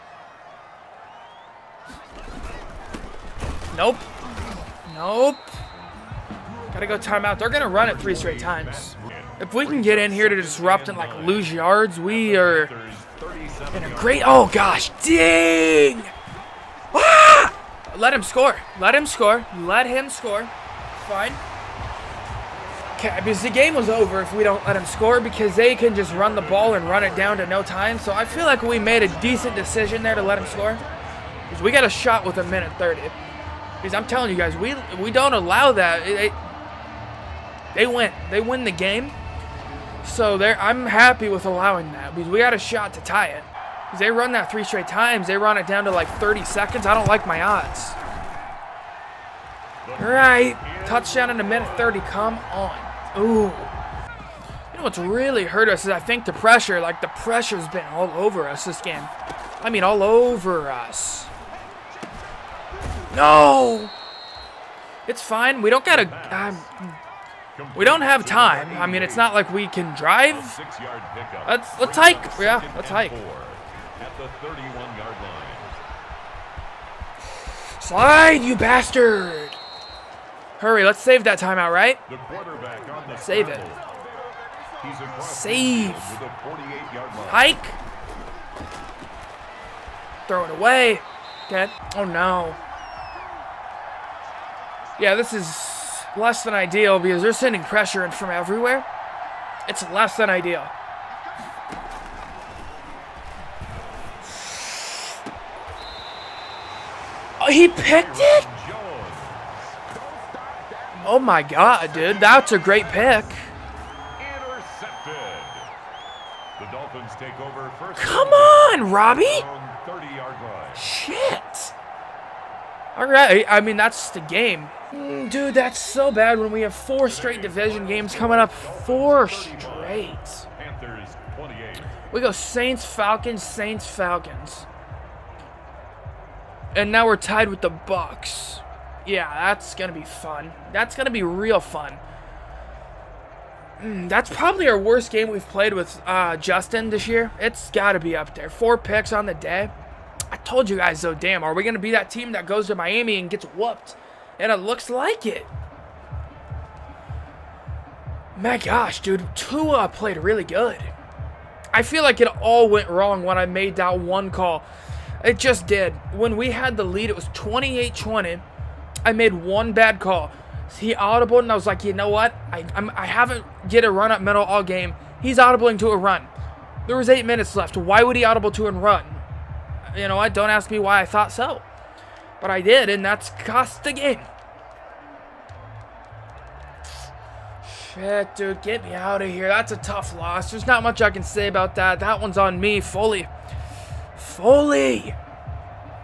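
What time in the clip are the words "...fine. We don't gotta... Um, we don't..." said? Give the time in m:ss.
1:05.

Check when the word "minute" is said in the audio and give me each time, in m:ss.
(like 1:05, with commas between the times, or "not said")
0:32, 0:51, 2:57.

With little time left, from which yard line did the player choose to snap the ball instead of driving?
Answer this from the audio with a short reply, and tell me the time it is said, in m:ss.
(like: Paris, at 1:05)
31-yard line, at 1:14.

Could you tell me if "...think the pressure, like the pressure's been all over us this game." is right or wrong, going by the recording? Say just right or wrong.
right.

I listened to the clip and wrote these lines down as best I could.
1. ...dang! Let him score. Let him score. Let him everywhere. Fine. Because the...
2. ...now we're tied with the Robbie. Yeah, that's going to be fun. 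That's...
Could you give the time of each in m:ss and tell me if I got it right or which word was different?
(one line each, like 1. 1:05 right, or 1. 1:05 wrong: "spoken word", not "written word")
1. 0:15 wrong: "score", not "everywhere"
2. 2:16 wrong: "Bucs", not "Robbie".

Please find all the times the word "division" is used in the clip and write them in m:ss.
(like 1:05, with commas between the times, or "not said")
2:07.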